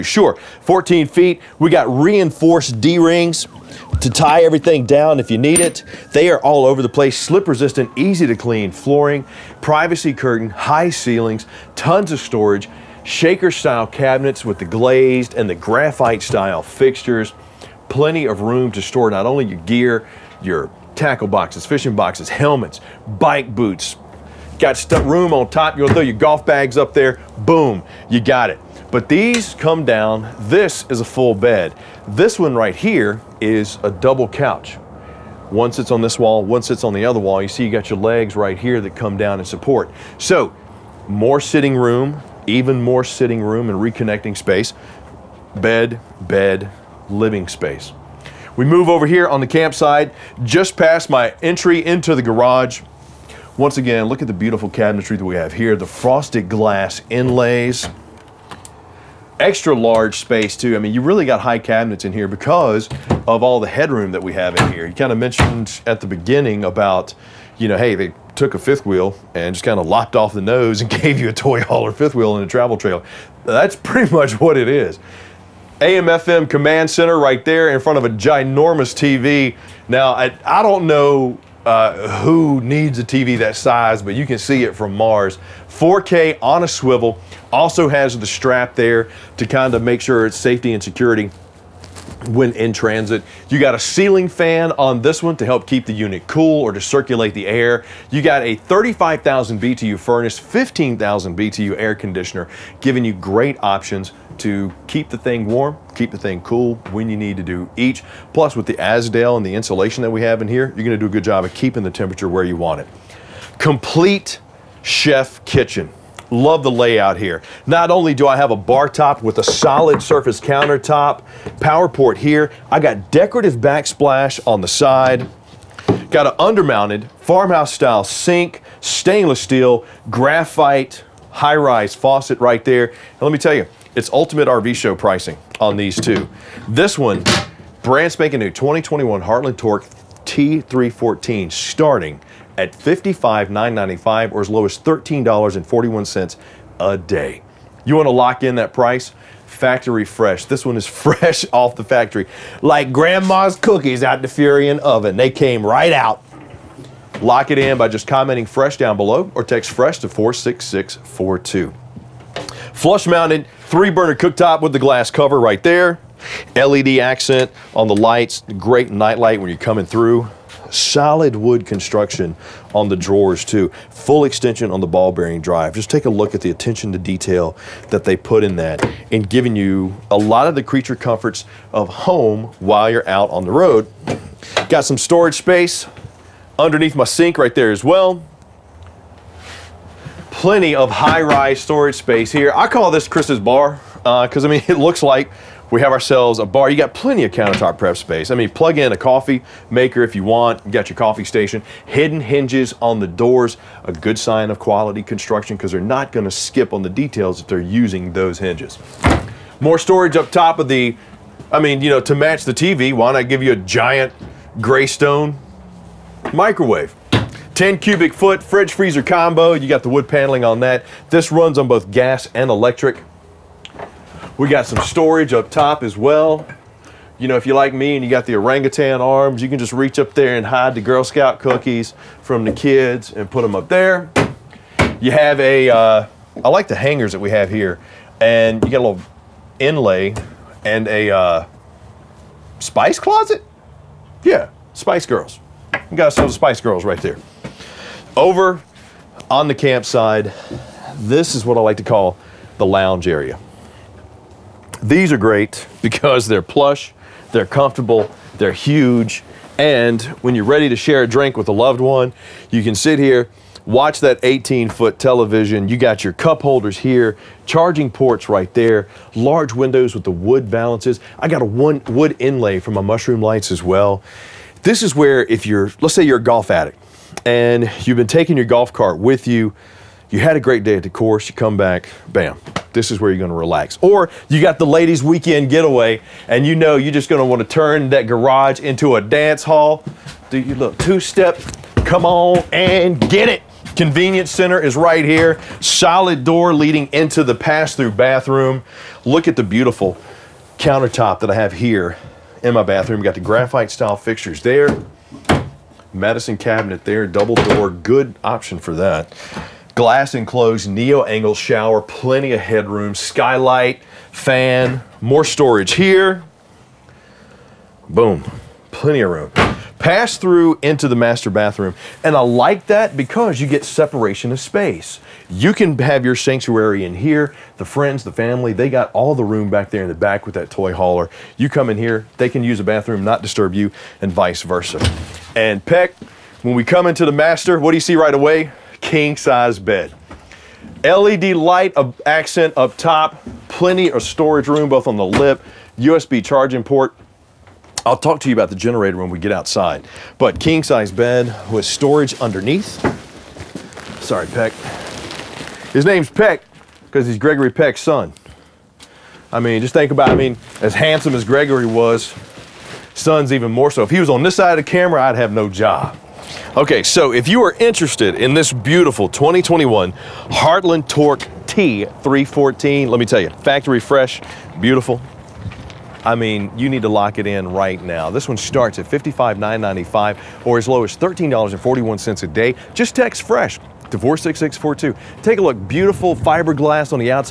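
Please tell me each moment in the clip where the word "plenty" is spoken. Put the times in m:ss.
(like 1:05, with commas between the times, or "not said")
0:17, 3:10, 3:16, 5:11, 5:18, 5:43.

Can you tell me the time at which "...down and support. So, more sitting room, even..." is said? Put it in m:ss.
0:39.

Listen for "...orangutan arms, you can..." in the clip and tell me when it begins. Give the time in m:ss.
3:48.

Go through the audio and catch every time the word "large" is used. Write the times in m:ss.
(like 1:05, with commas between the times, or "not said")
0:59, 4:29.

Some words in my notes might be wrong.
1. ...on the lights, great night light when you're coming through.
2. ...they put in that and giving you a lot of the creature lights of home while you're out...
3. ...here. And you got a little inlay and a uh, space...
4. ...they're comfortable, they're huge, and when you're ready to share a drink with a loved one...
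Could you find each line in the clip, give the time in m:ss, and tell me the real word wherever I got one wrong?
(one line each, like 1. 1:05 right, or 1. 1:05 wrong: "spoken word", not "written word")
1. 2:47 right
2. 2:58 wrong: "comforts", not "lights"
3. 3:57 wrong: "spice", not "space"
4. 4:17 right.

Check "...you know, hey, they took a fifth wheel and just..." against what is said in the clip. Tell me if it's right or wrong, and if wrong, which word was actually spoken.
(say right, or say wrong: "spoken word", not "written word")
right.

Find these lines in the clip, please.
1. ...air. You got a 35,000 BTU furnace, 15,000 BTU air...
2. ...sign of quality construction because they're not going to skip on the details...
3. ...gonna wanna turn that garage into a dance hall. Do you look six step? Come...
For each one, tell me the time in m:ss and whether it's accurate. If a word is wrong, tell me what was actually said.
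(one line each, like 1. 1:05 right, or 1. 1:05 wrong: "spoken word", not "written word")
1. 1:37 right
2. 3:24 right
3. 4:47 wrong: "two", not "six".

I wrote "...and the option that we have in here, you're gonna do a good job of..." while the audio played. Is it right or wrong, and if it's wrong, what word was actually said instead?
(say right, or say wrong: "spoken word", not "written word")
wrong: "insulation", not "option".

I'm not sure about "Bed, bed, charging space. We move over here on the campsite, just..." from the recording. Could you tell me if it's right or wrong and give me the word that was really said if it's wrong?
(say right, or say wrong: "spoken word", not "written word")
wrong: "living", not "charging".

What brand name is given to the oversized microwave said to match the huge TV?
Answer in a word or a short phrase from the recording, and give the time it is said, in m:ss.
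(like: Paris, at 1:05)
Greystone, at 3:34.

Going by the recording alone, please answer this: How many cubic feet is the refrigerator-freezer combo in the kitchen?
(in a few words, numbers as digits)
10.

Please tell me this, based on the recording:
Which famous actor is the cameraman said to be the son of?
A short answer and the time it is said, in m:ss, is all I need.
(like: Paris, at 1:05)
Gregory Peck, at 5:57.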